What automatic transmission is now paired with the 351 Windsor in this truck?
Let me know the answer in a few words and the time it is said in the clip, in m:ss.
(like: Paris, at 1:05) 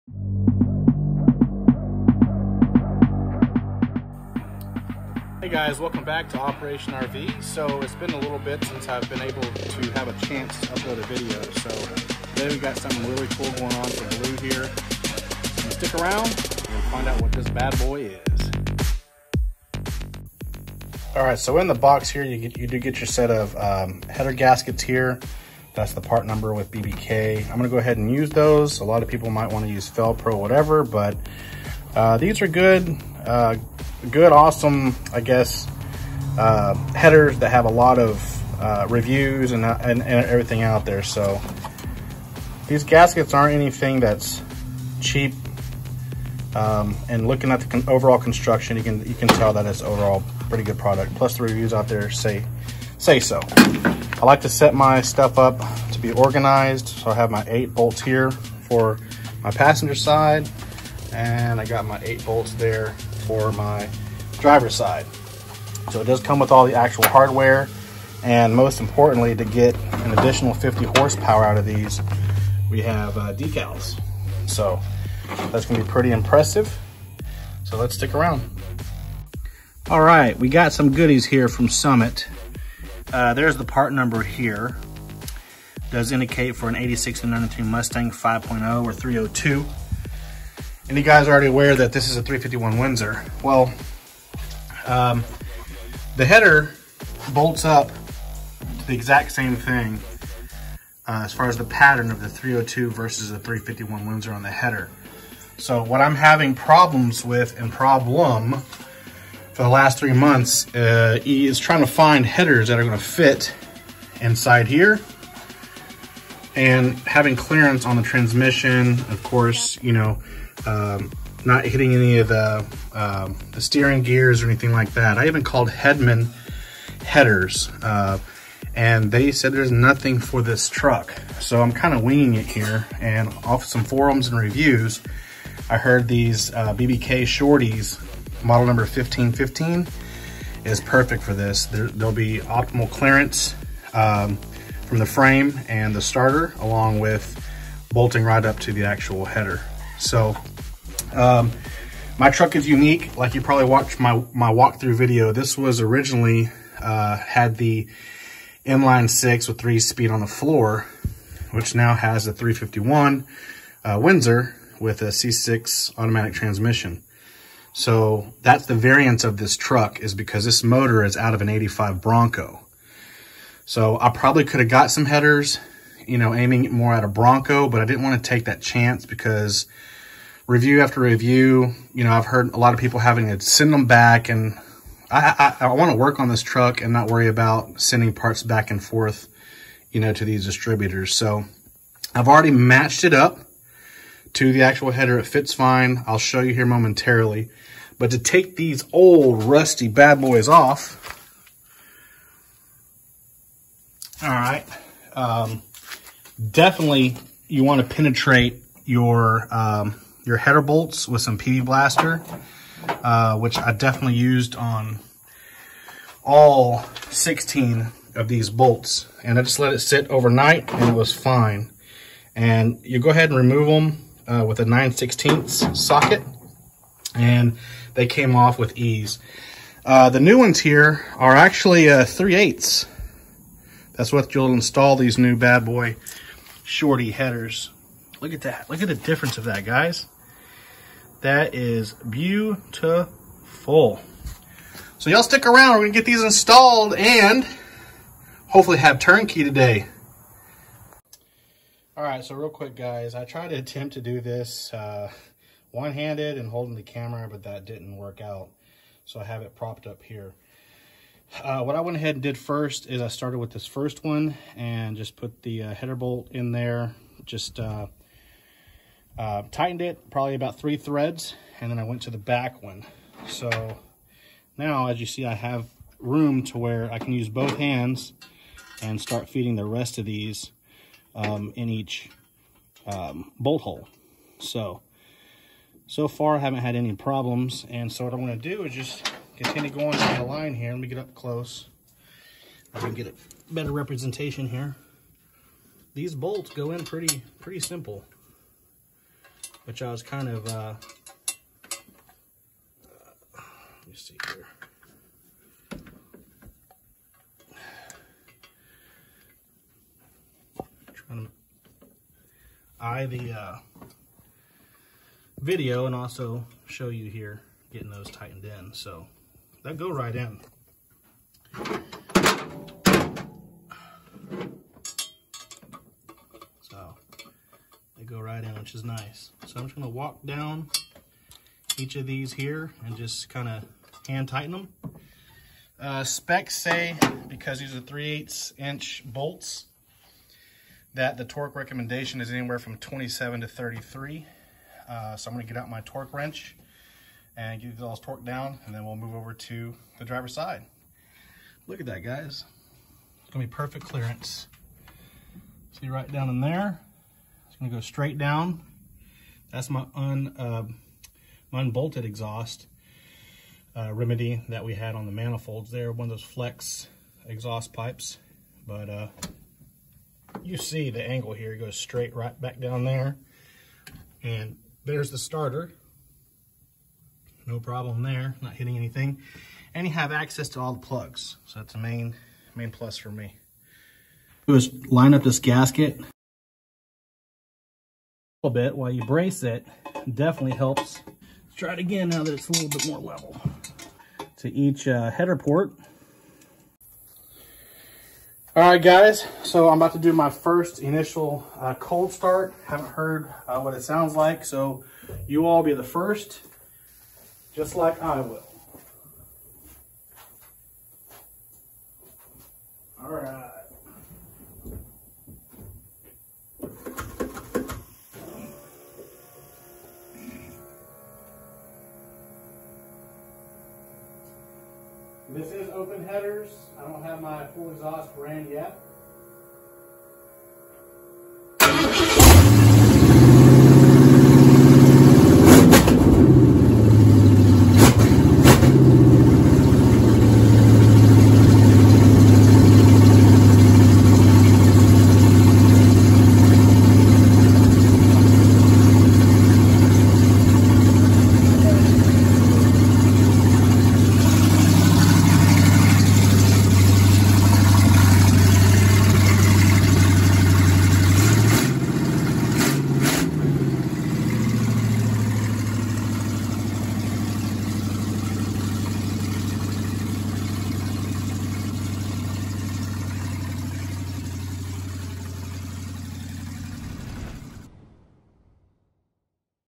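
C6, at 2:45.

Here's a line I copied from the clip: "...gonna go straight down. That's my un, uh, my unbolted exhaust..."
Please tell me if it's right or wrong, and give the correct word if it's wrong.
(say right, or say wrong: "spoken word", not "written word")
right.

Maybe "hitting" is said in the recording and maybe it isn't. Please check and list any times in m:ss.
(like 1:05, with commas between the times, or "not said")
2:01, 6:18.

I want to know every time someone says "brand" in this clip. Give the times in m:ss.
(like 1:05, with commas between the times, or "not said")
7:08.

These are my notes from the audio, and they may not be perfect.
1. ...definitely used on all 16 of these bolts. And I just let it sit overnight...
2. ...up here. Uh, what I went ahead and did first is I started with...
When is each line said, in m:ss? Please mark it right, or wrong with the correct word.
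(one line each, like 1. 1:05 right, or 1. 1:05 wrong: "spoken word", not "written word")
1. 3:33 right
2. 4:19 right.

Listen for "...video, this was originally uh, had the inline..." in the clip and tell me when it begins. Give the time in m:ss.
2:34.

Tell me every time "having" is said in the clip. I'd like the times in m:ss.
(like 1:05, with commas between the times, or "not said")
1:46, 1:57, 3:02.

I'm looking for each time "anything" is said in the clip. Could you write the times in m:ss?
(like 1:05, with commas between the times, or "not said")
0:43, 2:04, 6:18.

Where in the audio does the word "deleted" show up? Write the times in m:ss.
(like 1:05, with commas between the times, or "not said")
not said.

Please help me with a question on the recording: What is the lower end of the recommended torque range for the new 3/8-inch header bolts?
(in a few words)
27.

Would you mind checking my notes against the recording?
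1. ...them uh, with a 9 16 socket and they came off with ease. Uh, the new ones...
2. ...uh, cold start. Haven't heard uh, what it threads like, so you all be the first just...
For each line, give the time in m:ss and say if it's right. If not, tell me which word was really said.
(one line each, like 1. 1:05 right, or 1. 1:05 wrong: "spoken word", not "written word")
1. 3:43 right
2. 6:41 wrong: "sounds", not "threads".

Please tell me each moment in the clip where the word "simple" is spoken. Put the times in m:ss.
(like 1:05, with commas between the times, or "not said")
4:57.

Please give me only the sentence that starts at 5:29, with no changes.
So I'm just gonna walk down each of these here and just kind of hand tighten them.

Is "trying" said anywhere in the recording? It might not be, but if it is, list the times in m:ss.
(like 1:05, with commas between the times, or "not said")
1:51, 5:10.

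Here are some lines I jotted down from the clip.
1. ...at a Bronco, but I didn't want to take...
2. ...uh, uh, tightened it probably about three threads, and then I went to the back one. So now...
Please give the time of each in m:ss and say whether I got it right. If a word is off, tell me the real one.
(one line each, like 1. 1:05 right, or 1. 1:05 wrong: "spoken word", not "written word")
1. 2:56 right
2. 4:27 right.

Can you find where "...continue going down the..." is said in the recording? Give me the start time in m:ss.
4:49.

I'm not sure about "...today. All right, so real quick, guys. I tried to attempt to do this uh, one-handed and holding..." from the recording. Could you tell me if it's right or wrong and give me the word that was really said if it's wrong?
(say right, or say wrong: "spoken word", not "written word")
right.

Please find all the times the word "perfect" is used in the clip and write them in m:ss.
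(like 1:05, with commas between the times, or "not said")
2:20, 5:53.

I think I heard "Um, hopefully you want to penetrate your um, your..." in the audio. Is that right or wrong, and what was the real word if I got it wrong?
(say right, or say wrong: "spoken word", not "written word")
wrong: "definitely", not "hopefully".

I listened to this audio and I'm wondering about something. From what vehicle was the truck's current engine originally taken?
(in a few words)
85 Bronco.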